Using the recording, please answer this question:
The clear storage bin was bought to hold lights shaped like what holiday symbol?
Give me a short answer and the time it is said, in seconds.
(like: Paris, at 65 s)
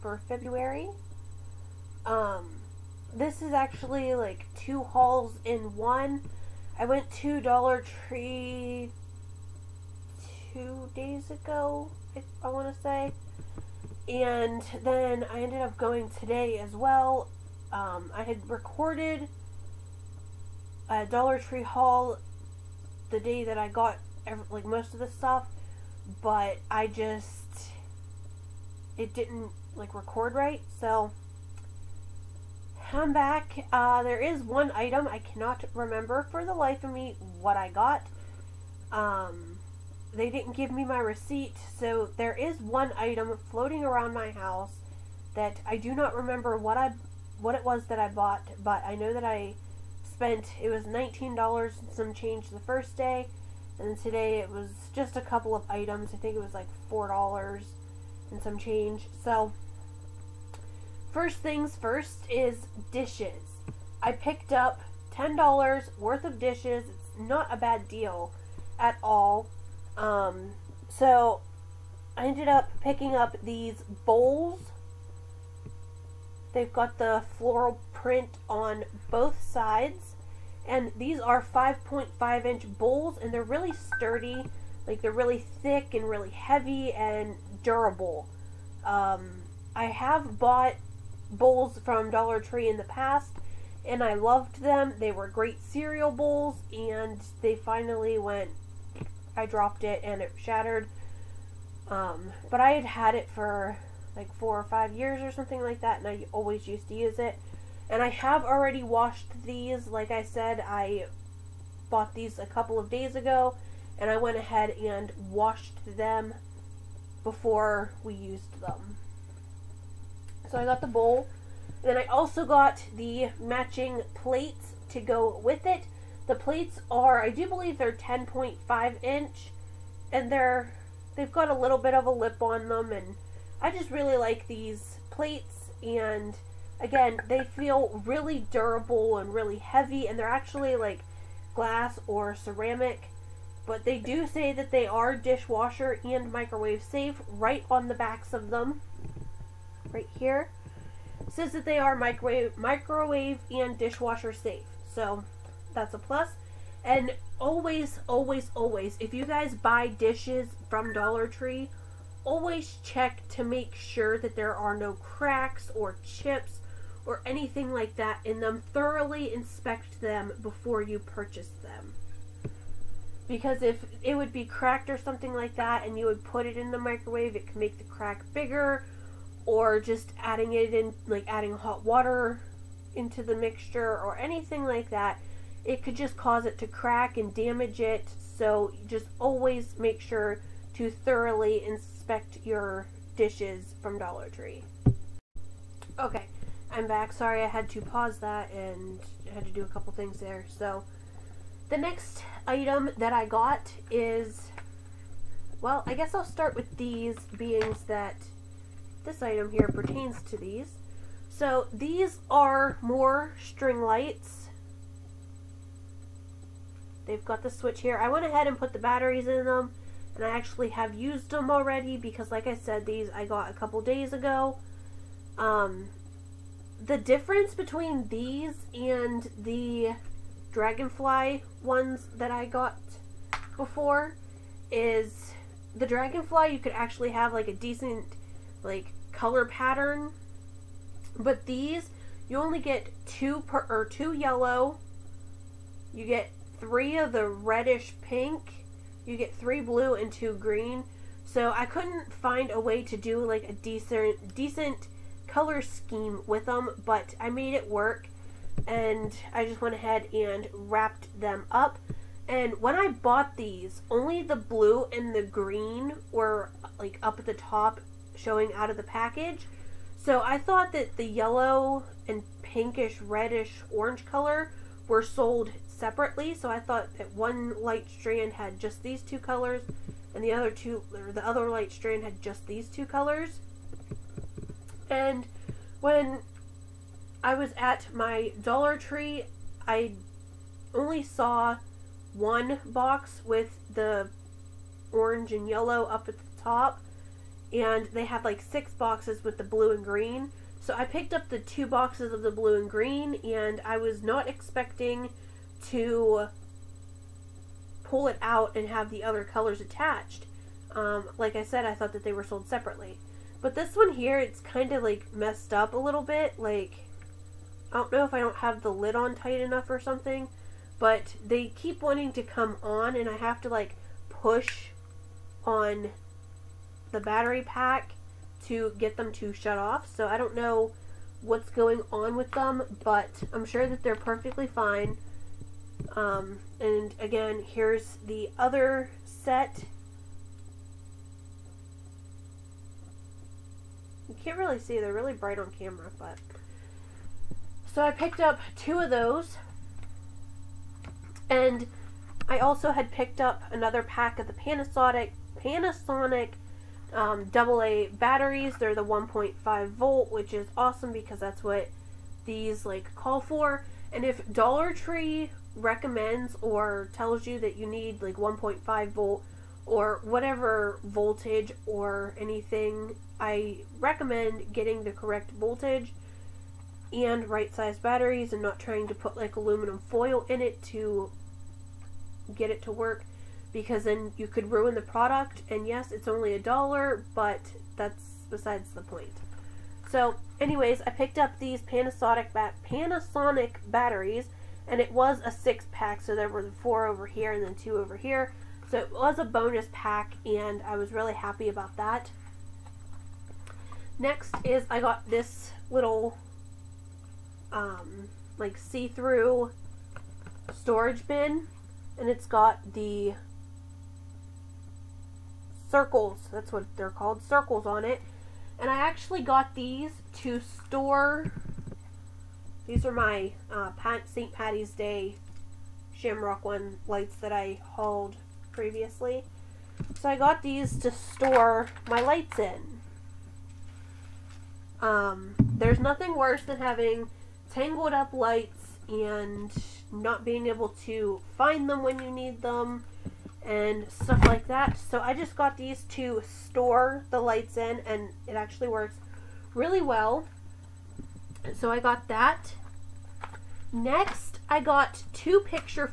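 Shamrock, at 425 s.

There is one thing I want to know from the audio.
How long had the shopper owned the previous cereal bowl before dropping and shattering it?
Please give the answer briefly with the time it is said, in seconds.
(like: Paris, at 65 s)
4 or 5 years, at 104 s.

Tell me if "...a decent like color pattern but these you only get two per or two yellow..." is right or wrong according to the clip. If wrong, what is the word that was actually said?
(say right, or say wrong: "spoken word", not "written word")
right.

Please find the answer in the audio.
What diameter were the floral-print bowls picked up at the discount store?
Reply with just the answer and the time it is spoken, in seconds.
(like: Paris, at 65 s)
5.5 inch, at 81 s.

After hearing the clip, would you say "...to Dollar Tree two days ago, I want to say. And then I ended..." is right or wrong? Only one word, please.
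right.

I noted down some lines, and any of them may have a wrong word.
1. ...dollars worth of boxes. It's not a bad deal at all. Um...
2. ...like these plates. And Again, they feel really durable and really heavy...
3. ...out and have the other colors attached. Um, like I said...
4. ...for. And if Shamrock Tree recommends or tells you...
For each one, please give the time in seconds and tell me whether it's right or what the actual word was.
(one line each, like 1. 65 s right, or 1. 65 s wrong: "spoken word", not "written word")
1. 65 s wrong: "dishes", not "boxes"
2. 134 s right
3. 308 s right
4. 363 s wrong: "Dollar", not "Shamrock".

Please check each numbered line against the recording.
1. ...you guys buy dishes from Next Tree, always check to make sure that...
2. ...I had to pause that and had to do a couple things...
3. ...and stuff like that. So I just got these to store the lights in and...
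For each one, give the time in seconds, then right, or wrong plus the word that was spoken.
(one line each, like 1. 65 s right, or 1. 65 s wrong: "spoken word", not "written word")
1. 159 s wrong: "Dollar", not "Next"
2. 197 s right
3. 443 s right.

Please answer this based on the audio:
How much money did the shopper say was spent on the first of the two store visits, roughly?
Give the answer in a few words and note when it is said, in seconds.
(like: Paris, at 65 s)
19 dollars, at 50 s.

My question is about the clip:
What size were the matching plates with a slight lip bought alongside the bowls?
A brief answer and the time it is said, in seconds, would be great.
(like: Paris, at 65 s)
10.5 inch, at 127 s.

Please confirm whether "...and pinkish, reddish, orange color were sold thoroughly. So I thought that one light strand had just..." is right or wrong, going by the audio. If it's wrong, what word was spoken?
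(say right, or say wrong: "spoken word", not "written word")
wrong: "separately", not "thoroughly".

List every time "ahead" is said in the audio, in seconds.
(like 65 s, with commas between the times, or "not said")
114 s, 218 s, 259 s.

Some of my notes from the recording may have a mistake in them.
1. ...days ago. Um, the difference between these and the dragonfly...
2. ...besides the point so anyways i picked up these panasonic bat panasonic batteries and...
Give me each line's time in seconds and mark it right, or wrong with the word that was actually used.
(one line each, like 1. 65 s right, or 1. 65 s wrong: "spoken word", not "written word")
1. 223 s right
2. 388 s right.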